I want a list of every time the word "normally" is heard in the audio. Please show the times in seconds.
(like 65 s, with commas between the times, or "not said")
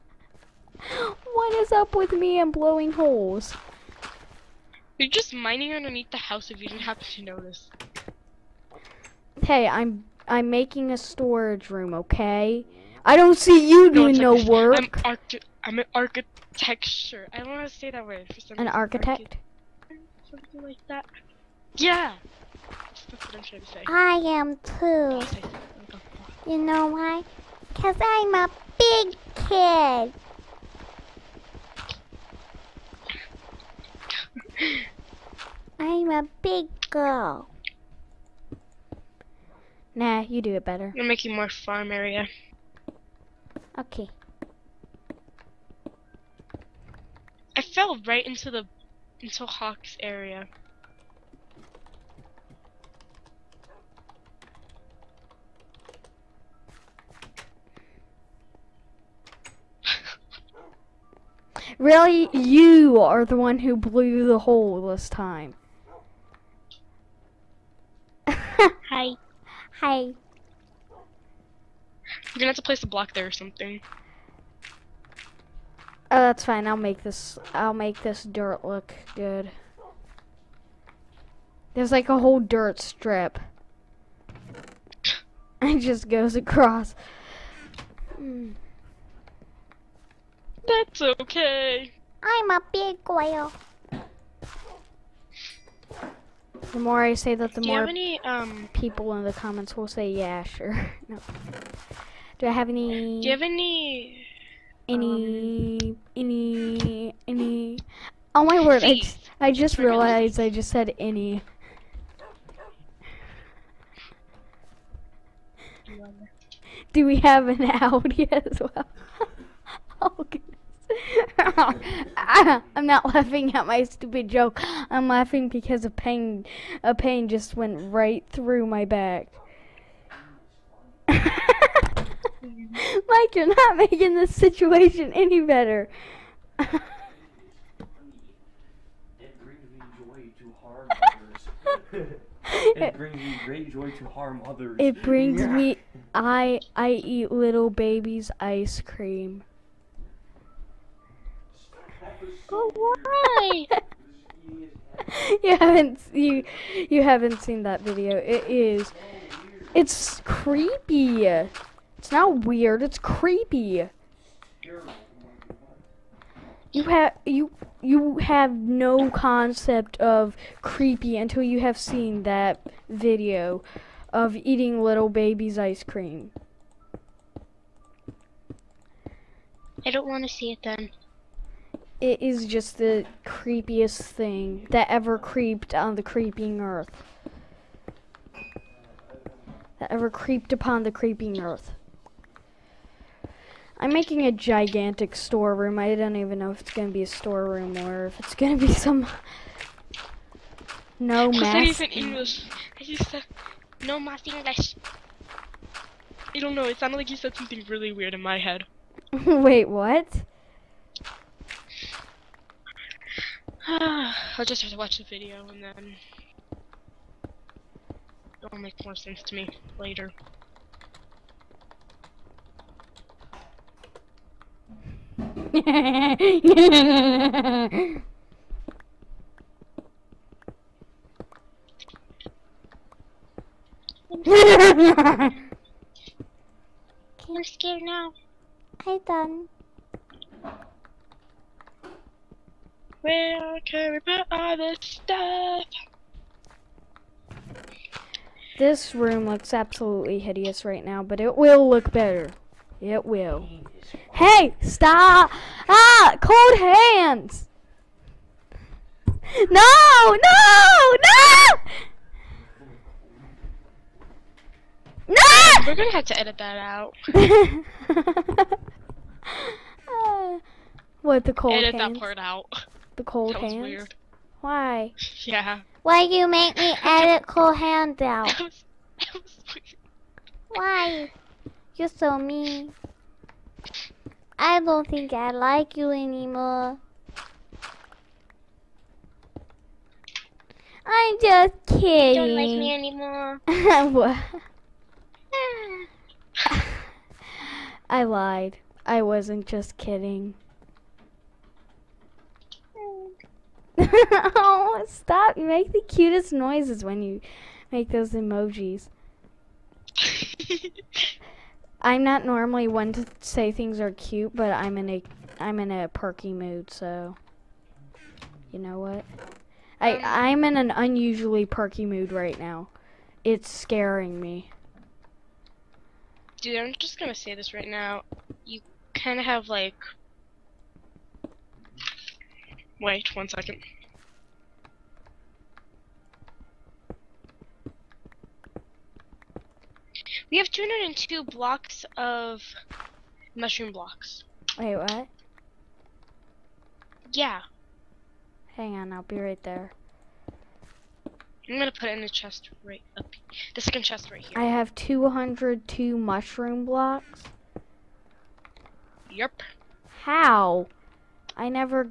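312 s.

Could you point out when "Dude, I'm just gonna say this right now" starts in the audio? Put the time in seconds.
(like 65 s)
326 s.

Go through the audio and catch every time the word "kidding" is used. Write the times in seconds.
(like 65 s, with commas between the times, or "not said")
291 s, 299 s.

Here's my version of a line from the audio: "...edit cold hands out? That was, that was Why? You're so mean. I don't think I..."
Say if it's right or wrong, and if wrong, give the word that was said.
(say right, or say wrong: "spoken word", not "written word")
right.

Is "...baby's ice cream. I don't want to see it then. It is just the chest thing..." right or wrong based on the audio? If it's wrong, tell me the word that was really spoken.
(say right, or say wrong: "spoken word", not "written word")
wrong: "creepiest", not "chest".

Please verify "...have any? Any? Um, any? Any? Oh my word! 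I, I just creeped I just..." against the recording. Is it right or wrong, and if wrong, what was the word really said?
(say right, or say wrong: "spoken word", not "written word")
wrong: "realized", not "creeped".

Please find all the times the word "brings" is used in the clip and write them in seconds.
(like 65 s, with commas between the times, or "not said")
139 s, 145 s.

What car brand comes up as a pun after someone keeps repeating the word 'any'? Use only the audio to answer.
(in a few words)
Audi.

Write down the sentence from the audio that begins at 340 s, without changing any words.
We have 202 blocks of mushroom blocks.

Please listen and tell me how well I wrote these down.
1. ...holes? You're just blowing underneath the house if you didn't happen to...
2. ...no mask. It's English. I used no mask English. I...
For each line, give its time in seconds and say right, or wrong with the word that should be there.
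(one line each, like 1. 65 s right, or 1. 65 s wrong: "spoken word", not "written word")
1. 2 s wrong: "mining", not "blowing"
2. 201 s right.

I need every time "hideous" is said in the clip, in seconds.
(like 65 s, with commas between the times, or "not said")
250 s.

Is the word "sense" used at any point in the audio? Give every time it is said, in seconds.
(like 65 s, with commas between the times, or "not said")
218 s.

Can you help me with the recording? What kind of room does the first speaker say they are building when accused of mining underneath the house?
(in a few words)
storage room.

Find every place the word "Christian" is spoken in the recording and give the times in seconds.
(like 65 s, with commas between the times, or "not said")
not said.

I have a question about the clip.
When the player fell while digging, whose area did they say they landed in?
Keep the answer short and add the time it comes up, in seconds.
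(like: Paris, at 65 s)
Hawk's area, at 49 s.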